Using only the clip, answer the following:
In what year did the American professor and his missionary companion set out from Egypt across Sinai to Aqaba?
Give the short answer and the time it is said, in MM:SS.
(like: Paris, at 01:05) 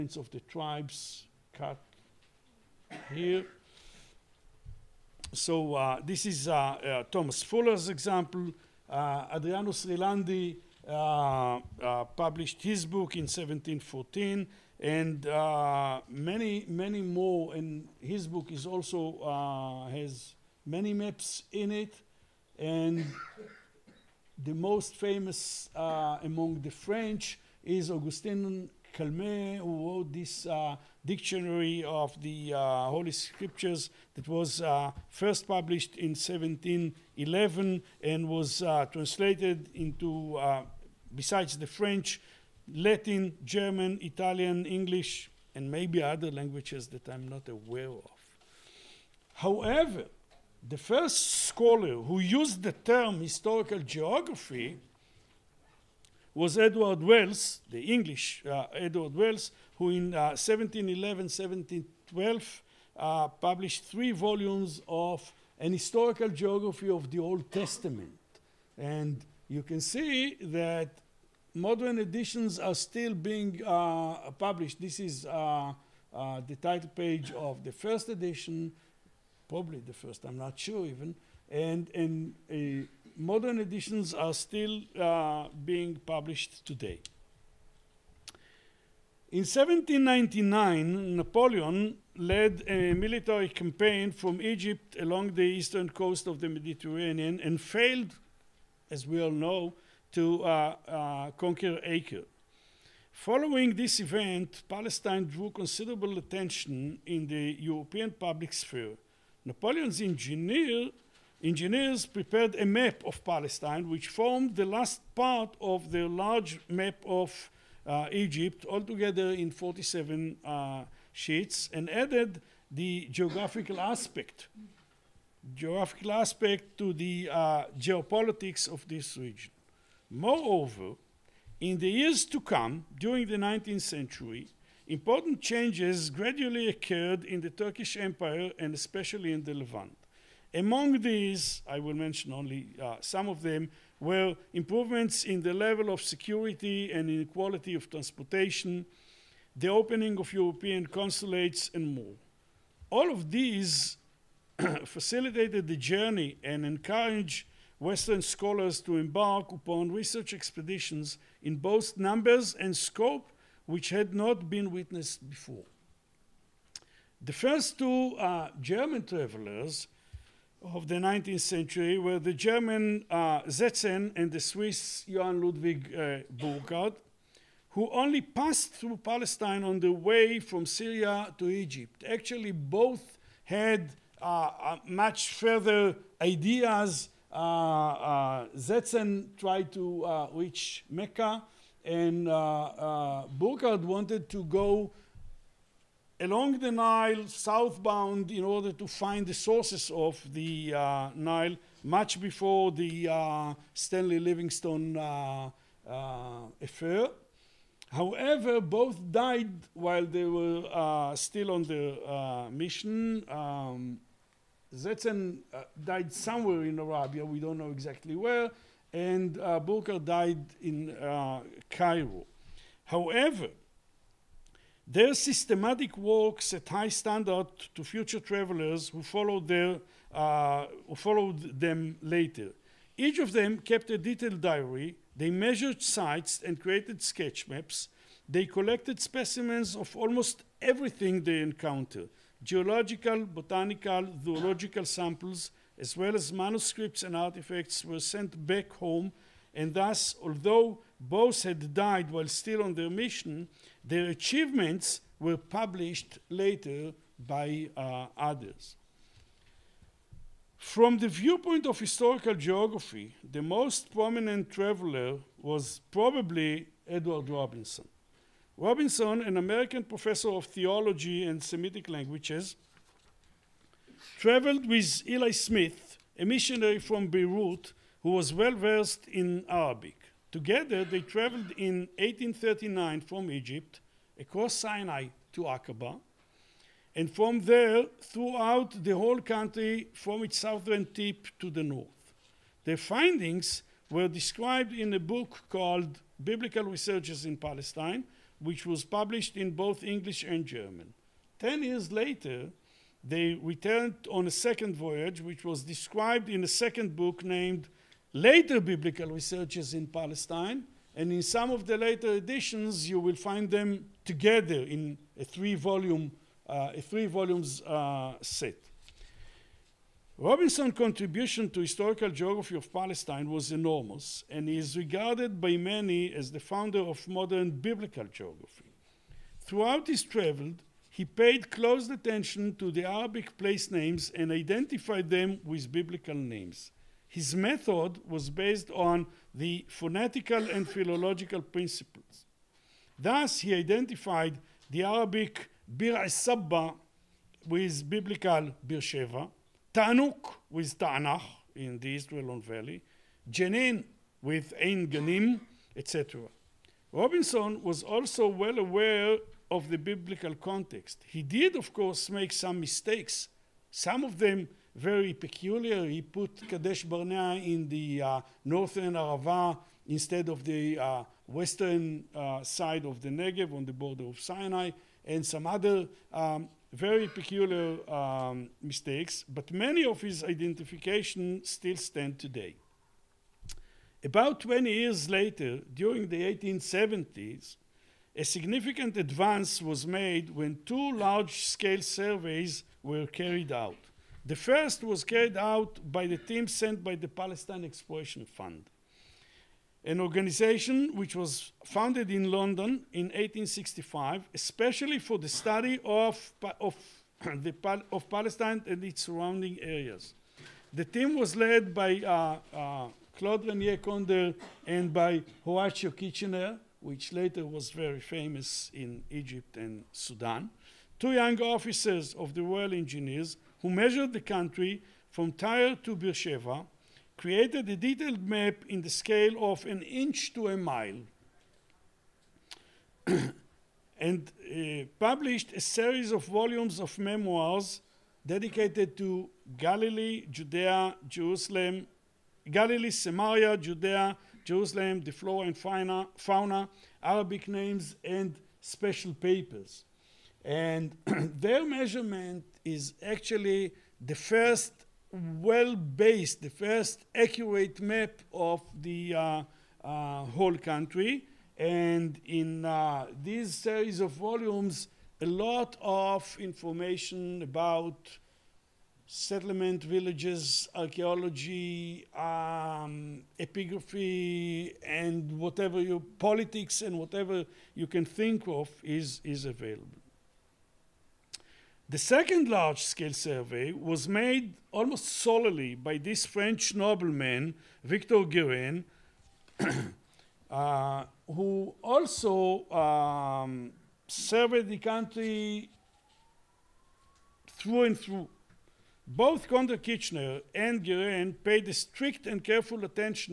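1839, at 04:41.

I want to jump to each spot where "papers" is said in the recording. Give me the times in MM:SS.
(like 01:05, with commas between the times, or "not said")
07:29.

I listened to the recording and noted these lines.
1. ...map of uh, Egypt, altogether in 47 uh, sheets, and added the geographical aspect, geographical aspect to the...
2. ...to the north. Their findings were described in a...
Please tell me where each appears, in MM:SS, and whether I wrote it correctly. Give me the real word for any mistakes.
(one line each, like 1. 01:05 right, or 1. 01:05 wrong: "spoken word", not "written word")
1. 01:56 right
2. 04:51 right.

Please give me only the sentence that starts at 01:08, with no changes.
And you can see that modern editions are still being uh, published.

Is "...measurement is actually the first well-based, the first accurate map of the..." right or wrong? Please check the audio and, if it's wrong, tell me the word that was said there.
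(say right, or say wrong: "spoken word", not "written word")
right.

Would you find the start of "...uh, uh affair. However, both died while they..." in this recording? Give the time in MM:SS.
03:24.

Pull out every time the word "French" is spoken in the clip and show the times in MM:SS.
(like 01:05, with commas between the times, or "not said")
00:26, 00:41, 08:06.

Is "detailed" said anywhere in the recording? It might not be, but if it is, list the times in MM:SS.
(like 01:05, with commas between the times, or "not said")
03:53, 07:07.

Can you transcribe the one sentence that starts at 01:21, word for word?
And, and uh, modern editions are still uh, being published today.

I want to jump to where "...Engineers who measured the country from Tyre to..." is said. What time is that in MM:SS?
07:02.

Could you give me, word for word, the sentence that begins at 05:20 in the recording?
Robinson's contribution to historical geography of Palestine was enormous, and is regarded by many as the founder of modern biblical geography.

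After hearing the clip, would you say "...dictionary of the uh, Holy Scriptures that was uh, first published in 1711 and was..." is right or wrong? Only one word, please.
right.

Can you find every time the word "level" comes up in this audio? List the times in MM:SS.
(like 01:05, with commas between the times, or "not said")
02:25.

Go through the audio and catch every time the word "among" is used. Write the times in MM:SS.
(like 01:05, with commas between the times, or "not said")
00:26, 02:20.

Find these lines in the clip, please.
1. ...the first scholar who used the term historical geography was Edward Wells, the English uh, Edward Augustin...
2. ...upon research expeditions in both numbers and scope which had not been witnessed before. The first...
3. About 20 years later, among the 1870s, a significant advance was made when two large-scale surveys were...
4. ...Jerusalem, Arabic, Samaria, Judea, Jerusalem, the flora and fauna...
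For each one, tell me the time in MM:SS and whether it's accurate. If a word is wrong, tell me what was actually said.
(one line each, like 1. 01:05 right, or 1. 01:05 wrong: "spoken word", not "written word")
1. 00:50 wrong: "Wells", not "Augustin"
2. 02:39 right
3. 06:24 wrong: "during", not "among"
4. 07:21 wrong: "Galilee", not "Arabic".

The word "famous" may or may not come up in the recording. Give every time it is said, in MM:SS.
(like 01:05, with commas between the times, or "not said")
00:24, 06:57.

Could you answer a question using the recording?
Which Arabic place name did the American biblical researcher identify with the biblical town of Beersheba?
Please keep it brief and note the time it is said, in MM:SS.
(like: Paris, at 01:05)
Bir Sabba, at 05:45.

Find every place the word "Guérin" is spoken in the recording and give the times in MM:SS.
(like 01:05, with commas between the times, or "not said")
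08:08, 08:20.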